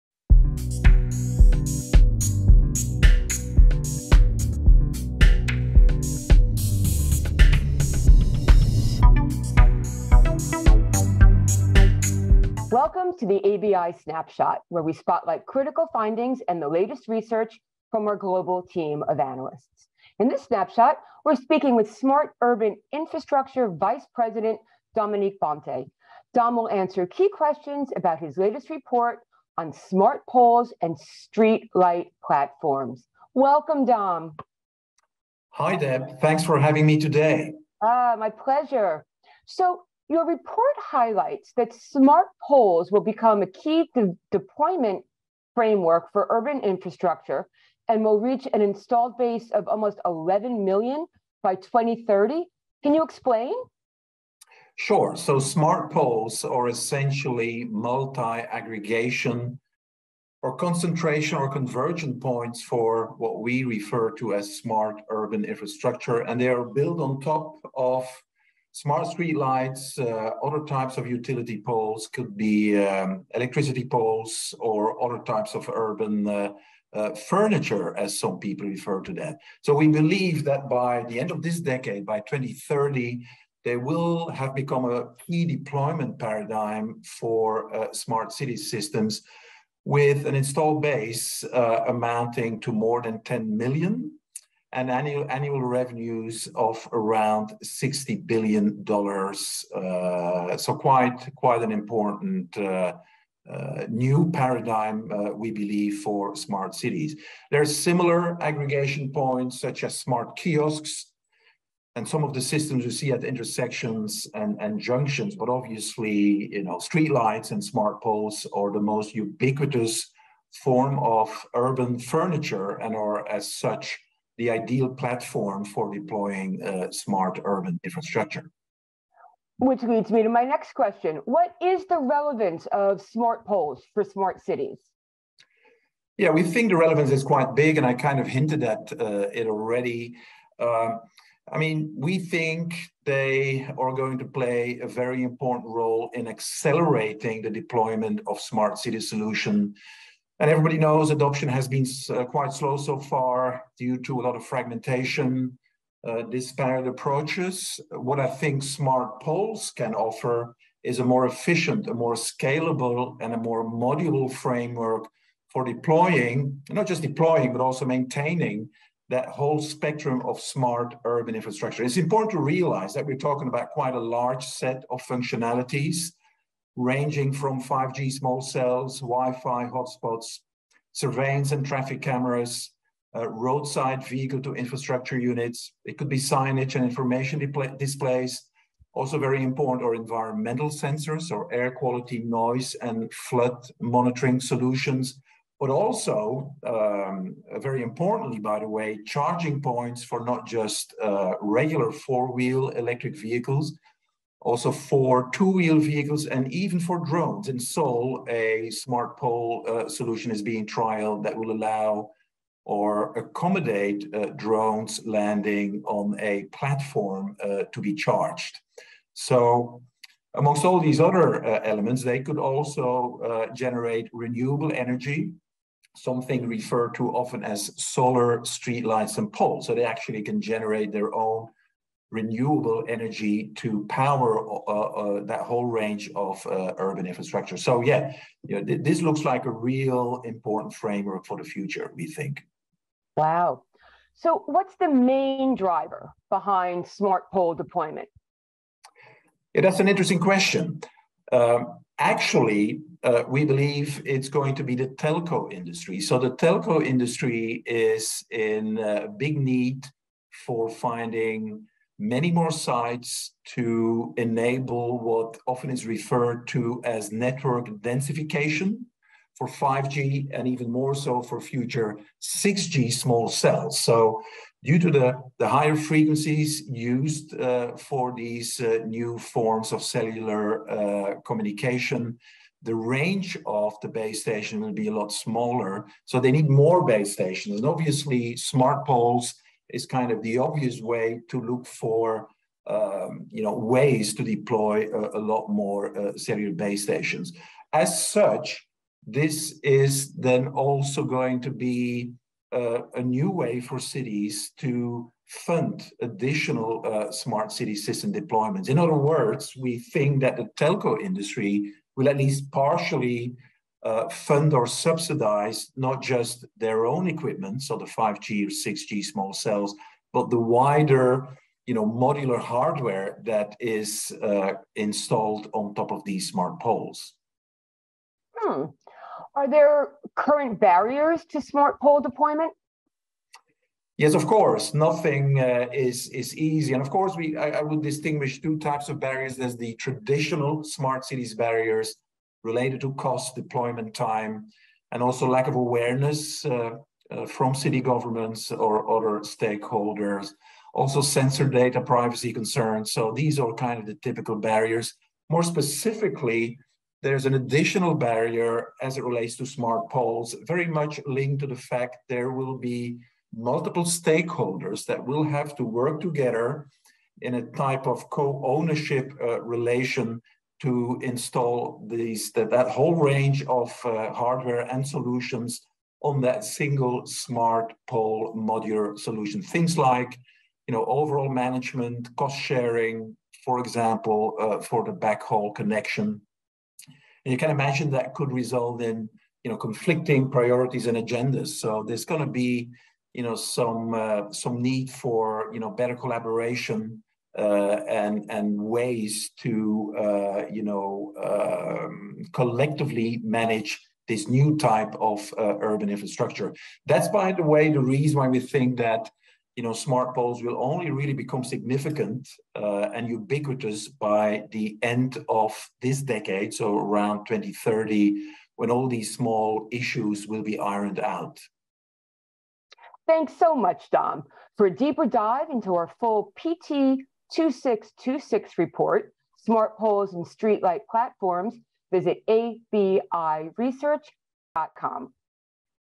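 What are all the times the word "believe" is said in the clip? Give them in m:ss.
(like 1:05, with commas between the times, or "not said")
1:19, 1:45, 4:13.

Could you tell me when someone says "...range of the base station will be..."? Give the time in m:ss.
4:42.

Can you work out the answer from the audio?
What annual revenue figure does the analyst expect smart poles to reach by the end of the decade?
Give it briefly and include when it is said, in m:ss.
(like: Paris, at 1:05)
$60 billion, at 1:37.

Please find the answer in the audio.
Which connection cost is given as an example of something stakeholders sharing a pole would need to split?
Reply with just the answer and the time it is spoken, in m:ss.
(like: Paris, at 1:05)
backhaul connection, at 6:24.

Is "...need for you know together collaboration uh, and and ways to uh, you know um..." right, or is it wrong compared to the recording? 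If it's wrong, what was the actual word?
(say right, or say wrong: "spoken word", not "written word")
wrong: "better", not "together".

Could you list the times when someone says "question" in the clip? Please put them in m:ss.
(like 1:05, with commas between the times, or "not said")
0:27, 2:10, 4:10.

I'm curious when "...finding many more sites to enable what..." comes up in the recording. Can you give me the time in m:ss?
4:20.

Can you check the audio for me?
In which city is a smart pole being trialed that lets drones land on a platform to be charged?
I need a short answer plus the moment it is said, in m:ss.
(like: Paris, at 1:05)
Seoul, at 3:27.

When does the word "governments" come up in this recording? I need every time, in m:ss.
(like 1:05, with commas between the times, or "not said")
5:47.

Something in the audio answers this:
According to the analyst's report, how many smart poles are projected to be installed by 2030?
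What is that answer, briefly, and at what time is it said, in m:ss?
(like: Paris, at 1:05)
almost 11 million, at 0:49.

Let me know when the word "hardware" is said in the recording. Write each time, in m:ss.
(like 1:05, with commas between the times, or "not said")
5:22, 6:14.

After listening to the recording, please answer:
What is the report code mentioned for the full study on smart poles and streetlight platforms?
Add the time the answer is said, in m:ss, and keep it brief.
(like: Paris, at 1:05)
PT 2626, at 7:06.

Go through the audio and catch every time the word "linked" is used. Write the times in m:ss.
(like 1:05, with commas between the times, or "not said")
6:01.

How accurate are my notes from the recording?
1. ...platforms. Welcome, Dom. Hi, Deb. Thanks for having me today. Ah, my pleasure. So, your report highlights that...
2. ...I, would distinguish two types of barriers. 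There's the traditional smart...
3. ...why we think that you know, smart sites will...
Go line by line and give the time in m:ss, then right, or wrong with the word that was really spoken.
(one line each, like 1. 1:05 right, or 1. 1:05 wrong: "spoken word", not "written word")
1. 0:32 right
2. 5:37 right
3. 6:48 wrong: "poles", not "sites".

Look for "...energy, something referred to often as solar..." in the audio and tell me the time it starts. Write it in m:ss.
3:44.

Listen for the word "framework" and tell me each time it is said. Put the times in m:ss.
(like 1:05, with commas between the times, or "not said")
0:45, 2:44, 4:00.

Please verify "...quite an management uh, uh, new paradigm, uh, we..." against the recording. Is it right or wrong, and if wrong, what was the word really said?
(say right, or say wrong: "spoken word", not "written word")
wrong: "important", not "management".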